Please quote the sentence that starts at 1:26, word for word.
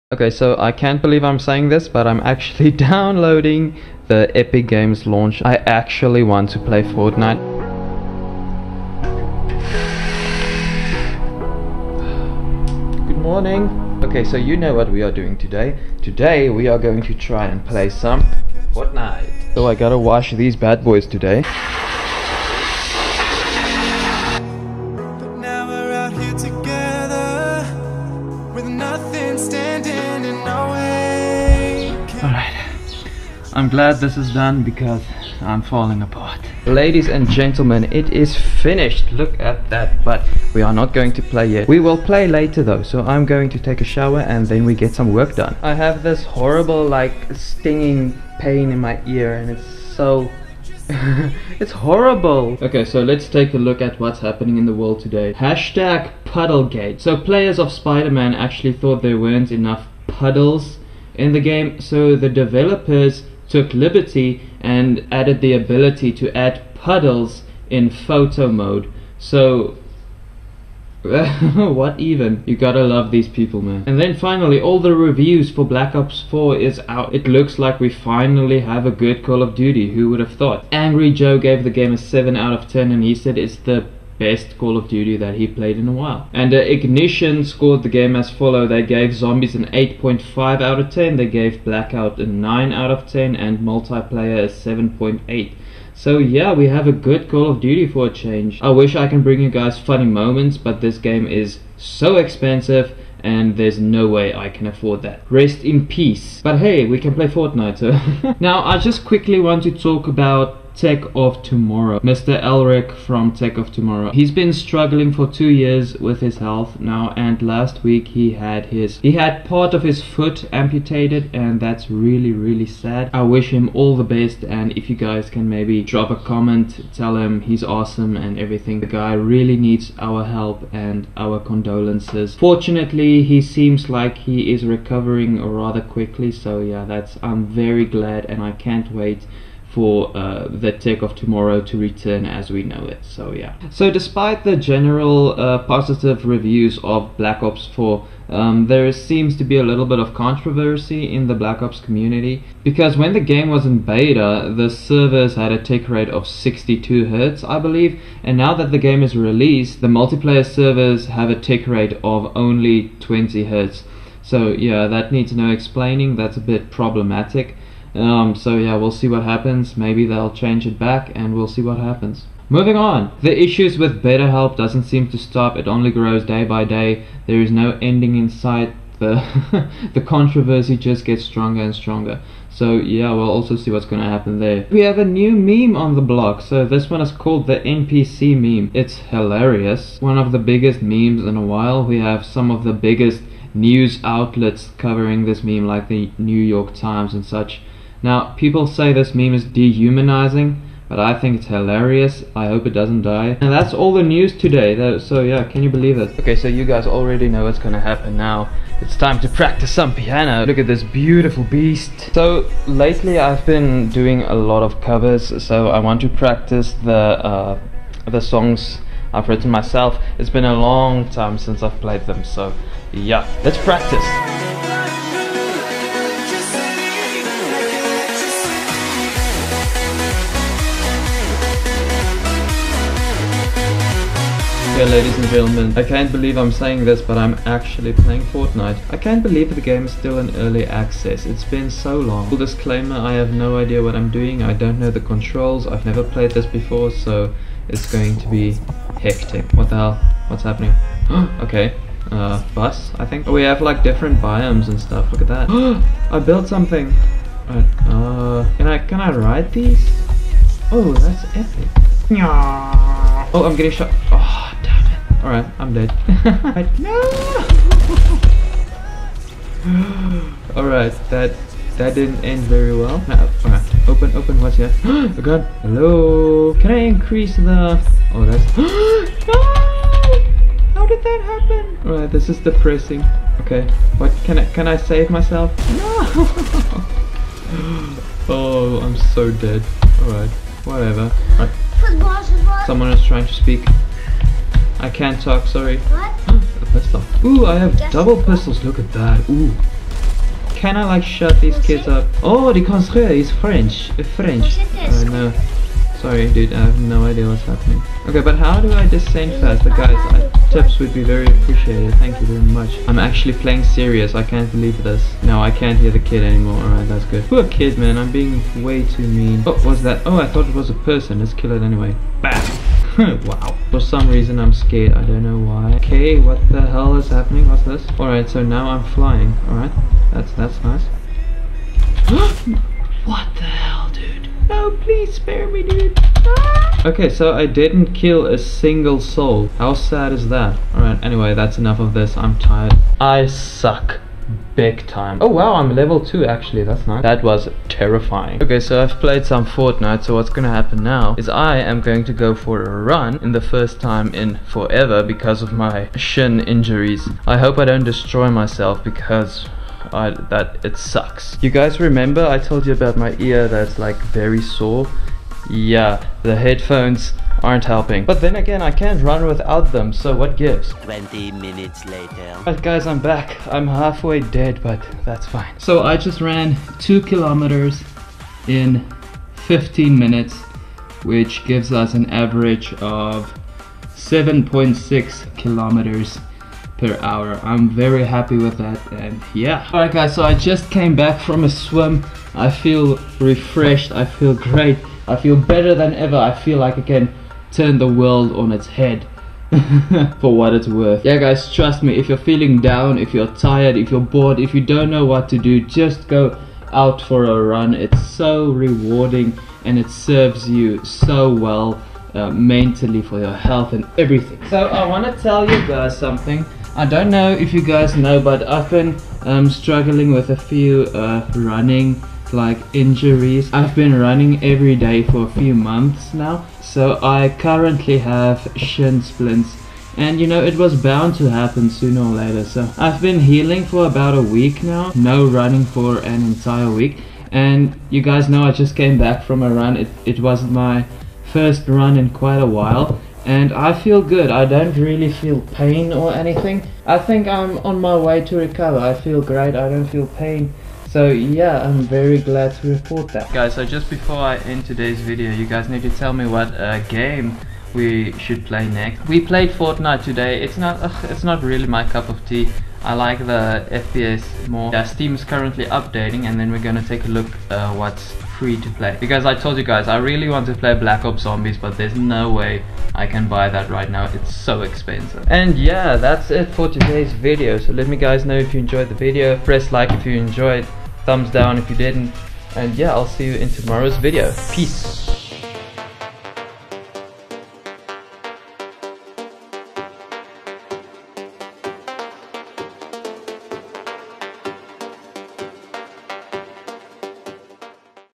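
And uh, Ignition scored the game as follow.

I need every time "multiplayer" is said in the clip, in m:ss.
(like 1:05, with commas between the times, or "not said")
1:33, 2:39.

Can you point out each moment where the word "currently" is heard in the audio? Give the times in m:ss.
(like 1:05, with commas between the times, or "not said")
7:07, 7:45.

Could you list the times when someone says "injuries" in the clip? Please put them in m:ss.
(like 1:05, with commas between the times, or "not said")
5:56, 7:02.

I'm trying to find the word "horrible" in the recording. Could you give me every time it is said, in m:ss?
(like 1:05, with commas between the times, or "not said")
0:46, 0:51.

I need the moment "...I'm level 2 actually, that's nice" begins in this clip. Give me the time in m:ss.
5:45.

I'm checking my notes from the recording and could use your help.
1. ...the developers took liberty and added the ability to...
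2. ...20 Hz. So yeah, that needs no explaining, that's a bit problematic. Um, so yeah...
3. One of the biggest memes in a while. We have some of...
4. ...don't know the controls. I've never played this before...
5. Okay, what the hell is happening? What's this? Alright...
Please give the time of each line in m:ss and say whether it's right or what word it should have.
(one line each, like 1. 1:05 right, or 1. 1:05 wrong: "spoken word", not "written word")
1. 1:02 right
2. 2:42 right
3. 3:10 right
4. 4:04 right
5. 5:25 right.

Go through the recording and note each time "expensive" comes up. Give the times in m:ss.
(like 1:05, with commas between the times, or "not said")
1:42, 7:54.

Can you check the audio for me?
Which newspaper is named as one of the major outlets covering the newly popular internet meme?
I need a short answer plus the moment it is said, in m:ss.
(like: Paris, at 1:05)
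The New York Times, at 3:16.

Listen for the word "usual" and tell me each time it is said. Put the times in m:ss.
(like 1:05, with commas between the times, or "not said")
not said.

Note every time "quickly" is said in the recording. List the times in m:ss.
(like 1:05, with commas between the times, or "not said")
1:49, 2:15.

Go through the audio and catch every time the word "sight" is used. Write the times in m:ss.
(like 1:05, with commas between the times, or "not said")
2:58.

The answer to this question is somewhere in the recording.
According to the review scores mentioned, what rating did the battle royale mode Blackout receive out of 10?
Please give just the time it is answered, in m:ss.
1:32.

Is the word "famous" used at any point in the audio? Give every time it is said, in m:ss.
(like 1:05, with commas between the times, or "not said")
not said.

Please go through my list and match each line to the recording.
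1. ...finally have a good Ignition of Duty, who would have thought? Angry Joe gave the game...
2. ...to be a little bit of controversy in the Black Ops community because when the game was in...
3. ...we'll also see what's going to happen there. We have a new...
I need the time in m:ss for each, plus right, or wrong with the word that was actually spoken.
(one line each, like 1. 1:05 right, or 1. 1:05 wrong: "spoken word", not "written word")
1. 1:17 wrong: "Call", not "Ignition"
2. 2:29 right
3. 3:03 right.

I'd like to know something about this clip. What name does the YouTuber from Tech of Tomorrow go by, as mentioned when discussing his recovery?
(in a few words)
Mr. Elric.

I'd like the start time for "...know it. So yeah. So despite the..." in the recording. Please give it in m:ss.
2:22.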